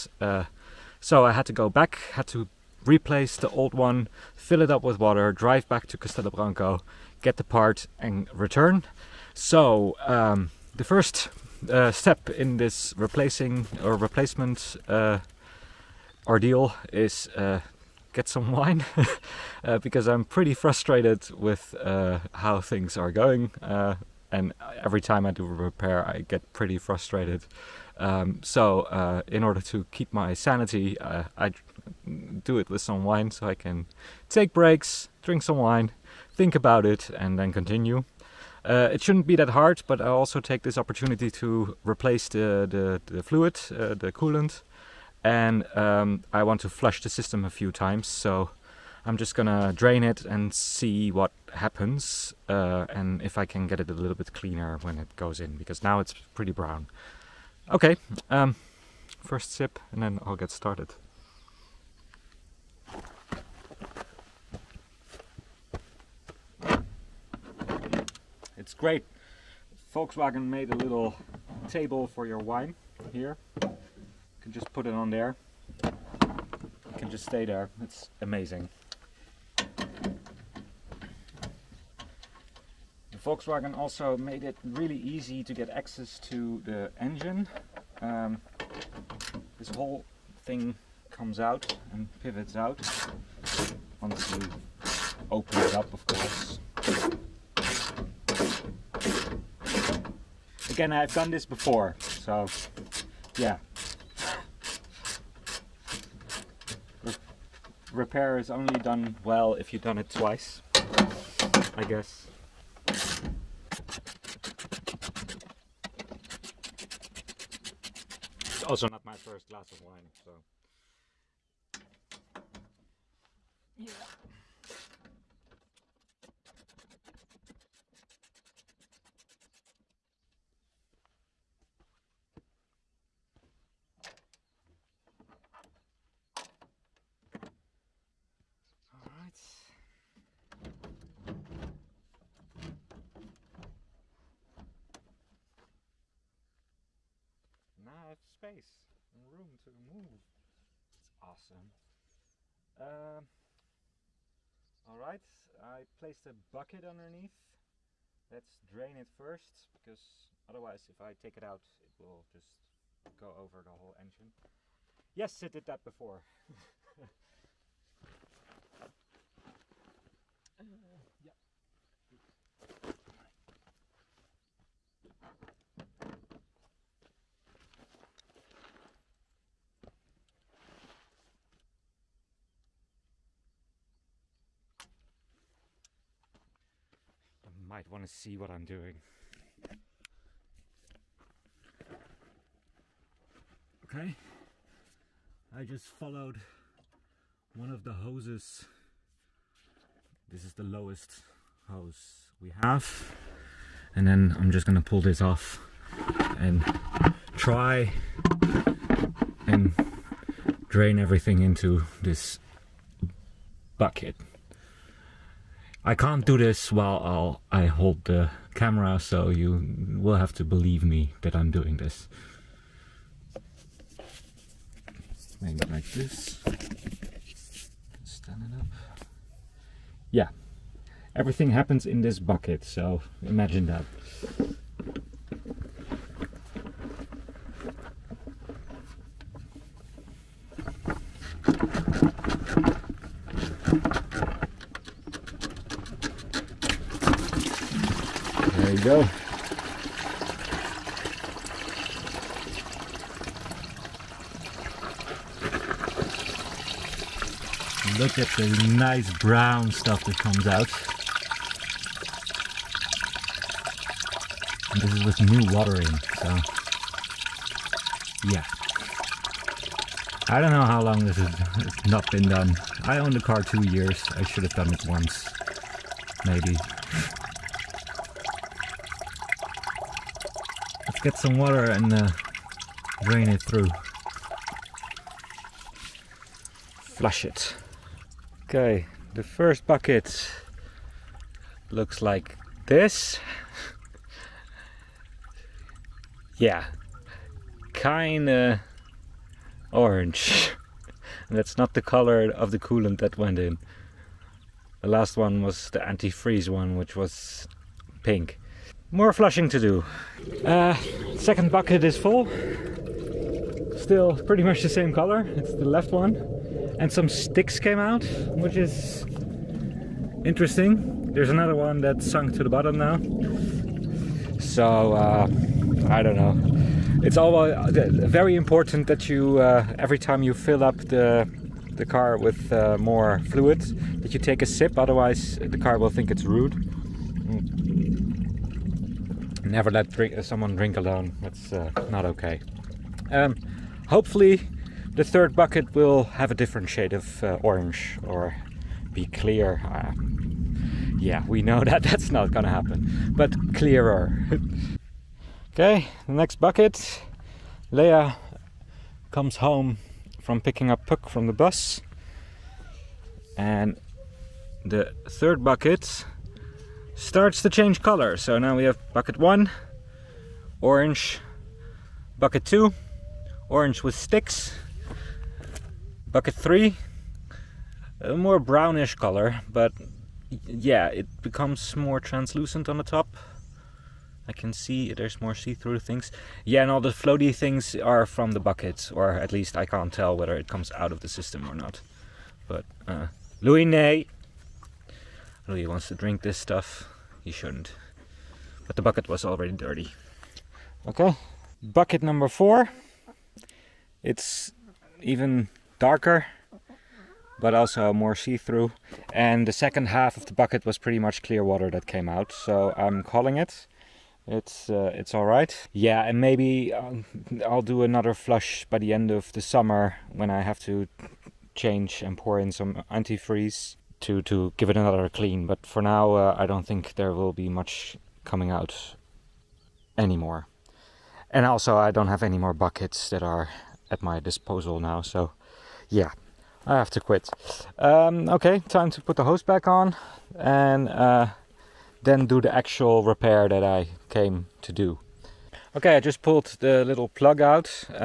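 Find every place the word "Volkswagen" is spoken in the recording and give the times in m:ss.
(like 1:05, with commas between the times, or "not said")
1:09, 1:23.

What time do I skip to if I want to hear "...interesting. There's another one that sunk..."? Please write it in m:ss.
5:20.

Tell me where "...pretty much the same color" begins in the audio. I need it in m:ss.
5:14.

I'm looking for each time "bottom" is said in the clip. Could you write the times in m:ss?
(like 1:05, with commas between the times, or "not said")
5:22.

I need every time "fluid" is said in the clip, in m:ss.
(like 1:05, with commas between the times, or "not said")
0:43, 5:33.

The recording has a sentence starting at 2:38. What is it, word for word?
Let's drain it first, because otherwise if I take it out, it will just go over the whole engine.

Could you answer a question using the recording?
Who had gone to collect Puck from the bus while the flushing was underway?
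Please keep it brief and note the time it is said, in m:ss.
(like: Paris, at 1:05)
Lea, at 5:57.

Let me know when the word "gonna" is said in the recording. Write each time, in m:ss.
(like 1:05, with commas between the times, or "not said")
0:49, 3:24, 5:52.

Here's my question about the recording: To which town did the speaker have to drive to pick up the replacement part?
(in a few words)
Castelo Branco.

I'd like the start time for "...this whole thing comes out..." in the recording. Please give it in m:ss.
1:29.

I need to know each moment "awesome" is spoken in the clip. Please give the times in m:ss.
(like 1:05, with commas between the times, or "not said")
2:31.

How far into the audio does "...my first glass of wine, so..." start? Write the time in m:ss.
1:59.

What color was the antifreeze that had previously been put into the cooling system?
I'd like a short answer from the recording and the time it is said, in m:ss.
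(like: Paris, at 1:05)
Pink, at 5:08.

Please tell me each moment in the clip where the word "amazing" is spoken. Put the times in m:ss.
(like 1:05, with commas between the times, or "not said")
1:18.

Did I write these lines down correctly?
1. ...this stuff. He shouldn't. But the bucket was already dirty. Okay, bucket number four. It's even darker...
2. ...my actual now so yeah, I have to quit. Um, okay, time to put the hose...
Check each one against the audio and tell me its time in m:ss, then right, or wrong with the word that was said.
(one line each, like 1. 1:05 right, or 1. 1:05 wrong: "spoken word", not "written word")
1. 6:36 right
2. 7:14 wrong: "disposal", not "actual".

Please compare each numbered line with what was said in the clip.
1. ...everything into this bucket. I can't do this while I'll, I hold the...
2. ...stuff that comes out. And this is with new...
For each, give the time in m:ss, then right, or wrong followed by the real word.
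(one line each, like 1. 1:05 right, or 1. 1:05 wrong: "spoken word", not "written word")
1. 3:30 right
2. 4:19 right.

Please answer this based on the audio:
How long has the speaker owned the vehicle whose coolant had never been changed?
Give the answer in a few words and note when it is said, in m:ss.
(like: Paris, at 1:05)
2 years, at 4:33.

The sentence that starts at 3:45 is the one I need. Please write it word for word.
Maybe like this yeah, everything happens in this bucket, so imagine that.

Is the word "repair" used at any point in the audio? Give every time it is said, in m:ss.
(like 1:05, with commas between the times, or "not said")
0:25, 1:47, 7:23.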